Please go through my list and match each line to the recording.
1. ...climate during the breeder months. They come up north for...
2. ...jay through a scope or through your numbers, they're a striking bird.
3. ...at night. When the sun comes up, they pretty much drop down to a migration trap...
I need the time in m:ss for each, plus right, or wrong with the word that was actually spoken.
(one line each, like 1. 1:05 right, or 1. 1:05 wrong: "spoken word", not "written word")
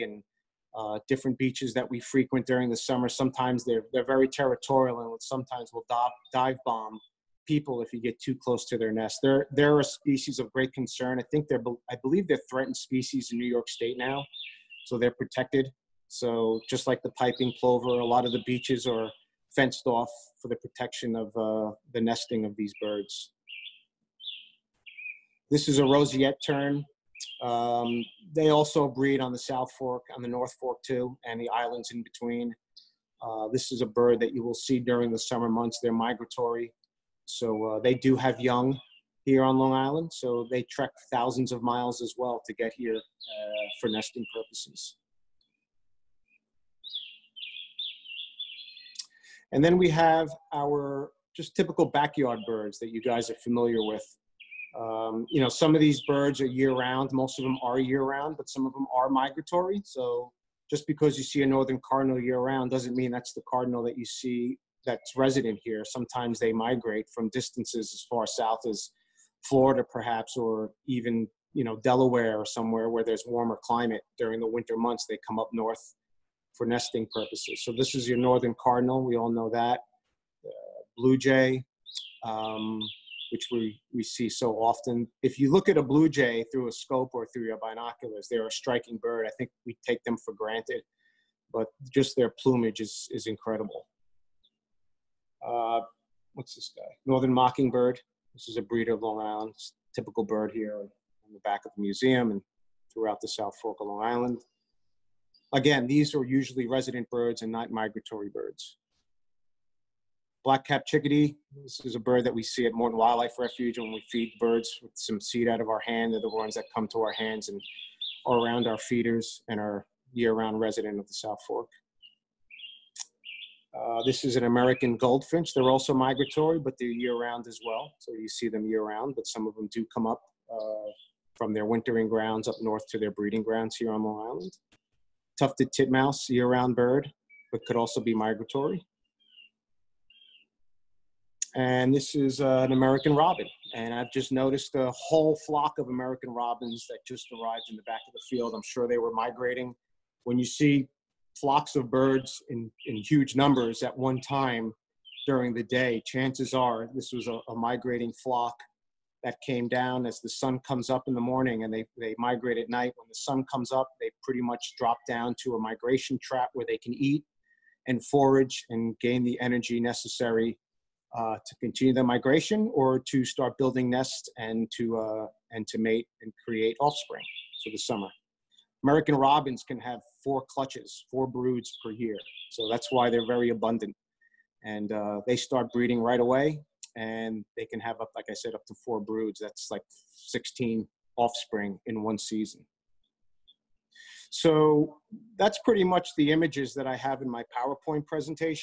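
1. 1:13 wrong: "winter", not "breeder"
2. 1:26 wrong: "binoculars", not "numbers"
3. 2:42 right.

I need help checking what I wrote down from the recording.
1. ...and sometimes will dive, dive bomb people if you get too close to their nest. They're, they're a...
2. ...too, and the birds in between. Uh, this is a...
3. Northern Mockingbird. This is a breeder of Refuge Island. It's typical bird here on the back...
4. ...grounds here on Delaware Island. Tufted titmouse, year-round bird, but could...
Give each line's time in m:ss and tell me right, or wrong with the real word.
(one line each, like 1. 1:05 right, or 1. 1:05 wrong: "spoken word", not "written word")
1. 0:05 right
2. 0:30 wrong: "islands", not "birds"
3. 1:37 wrong: "Long", not "Refuge"
4. 2:13 wrong: "Long", not "Delaware".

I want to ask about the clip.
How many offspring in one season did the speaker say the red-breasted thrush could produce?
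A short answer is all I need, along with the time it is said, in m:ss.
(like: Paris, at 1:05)
16, at 3:10.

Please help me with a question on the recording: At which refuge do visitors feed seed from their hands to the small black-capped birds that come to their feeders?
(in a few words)
Morton Wildlife Refuge.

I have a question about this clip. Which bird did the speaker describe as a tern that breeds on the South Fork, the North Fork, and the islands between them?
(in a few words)
Roseate tern.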